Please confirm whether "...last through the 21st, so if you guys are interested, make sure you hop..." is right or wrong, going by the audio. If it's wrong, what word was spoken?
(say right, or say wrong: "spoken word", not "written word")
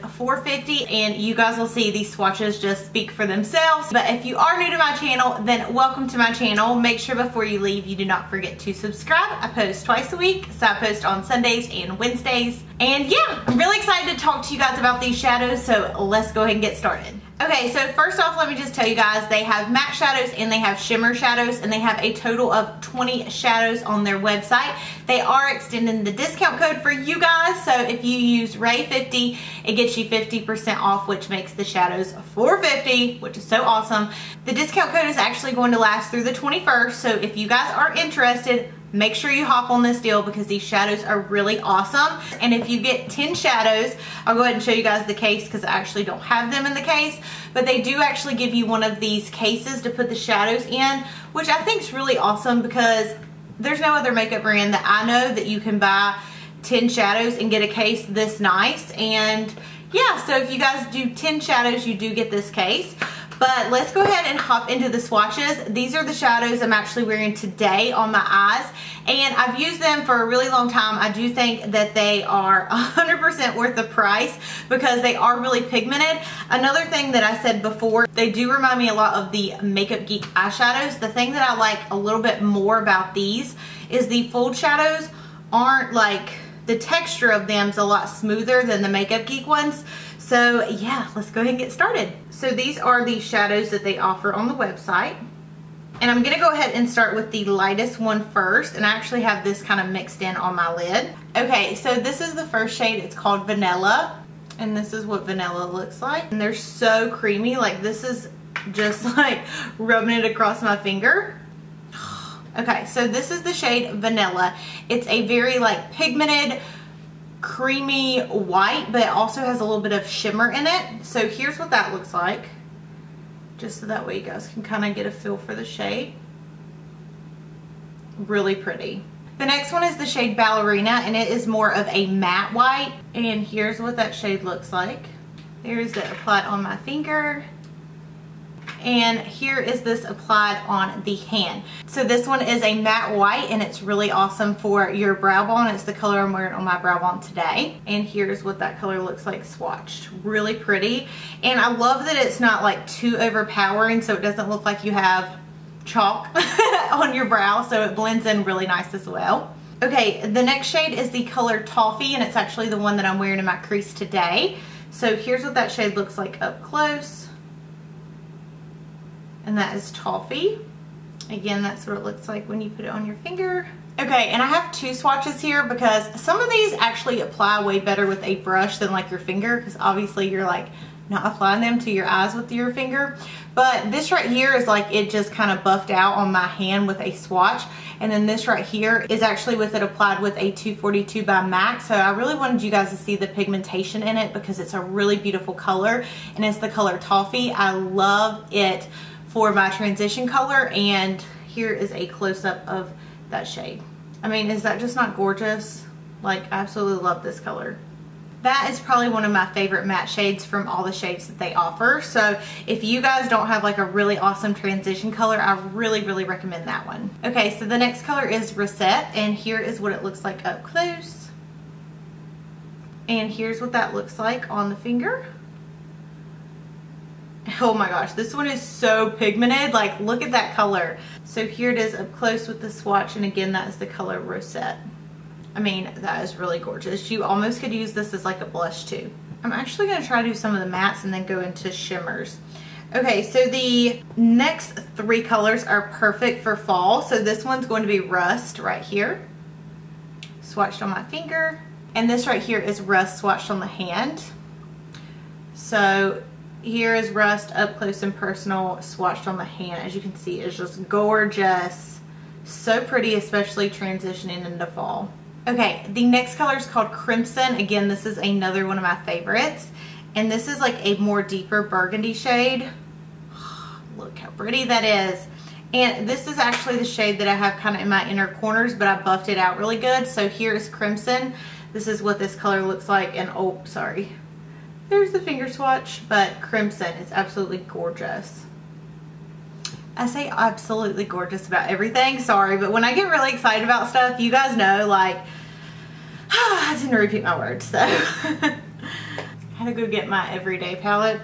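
right.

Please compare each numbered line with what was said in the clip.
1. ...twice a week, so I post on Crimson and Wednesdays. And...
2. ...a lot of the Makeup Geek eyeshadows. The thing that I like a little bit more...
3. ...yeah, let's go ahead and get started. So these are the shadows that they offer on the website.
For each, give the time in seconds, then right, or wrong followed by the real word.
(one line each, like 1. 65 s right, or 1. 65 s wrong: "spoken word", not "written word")
1. 9 s wrong: "Sundays", not "Crimson"
2. 78 s right
3. 90 s right.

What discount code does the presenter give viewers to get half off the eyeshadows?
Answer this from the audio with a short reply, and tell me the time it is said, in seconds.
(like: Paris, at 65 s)
RAE50, at 28 s.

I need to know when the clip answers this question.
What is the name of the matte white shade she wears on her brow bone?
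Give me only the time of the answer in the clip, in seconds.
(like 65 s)
130 s.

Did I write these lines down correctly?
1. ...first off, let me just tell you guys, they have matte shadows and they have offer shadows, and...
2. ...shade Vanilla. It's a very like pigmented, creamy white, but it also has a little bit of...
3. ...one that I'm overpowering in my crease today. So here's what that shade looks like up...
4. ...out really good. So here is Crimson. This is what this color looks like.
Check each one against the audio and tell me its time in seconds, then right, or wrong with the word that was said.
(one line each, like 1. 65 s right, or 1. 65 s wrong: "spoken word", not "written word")
1. 17 s wrong: "shimmer", not "offer"
2. 113 s right
3. 162 s wrong: "wearing", not "overpowering"
4. 279 s right.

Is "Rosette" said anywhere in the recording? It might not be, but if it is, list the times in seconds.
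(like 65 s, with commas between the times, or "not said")
218 s, 234 s.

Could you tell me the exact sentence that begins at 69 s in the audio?
And I've used them for a really long time.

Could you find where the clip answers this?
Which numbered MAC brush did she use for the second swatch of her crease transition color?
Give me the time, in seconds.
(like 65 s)
190 s.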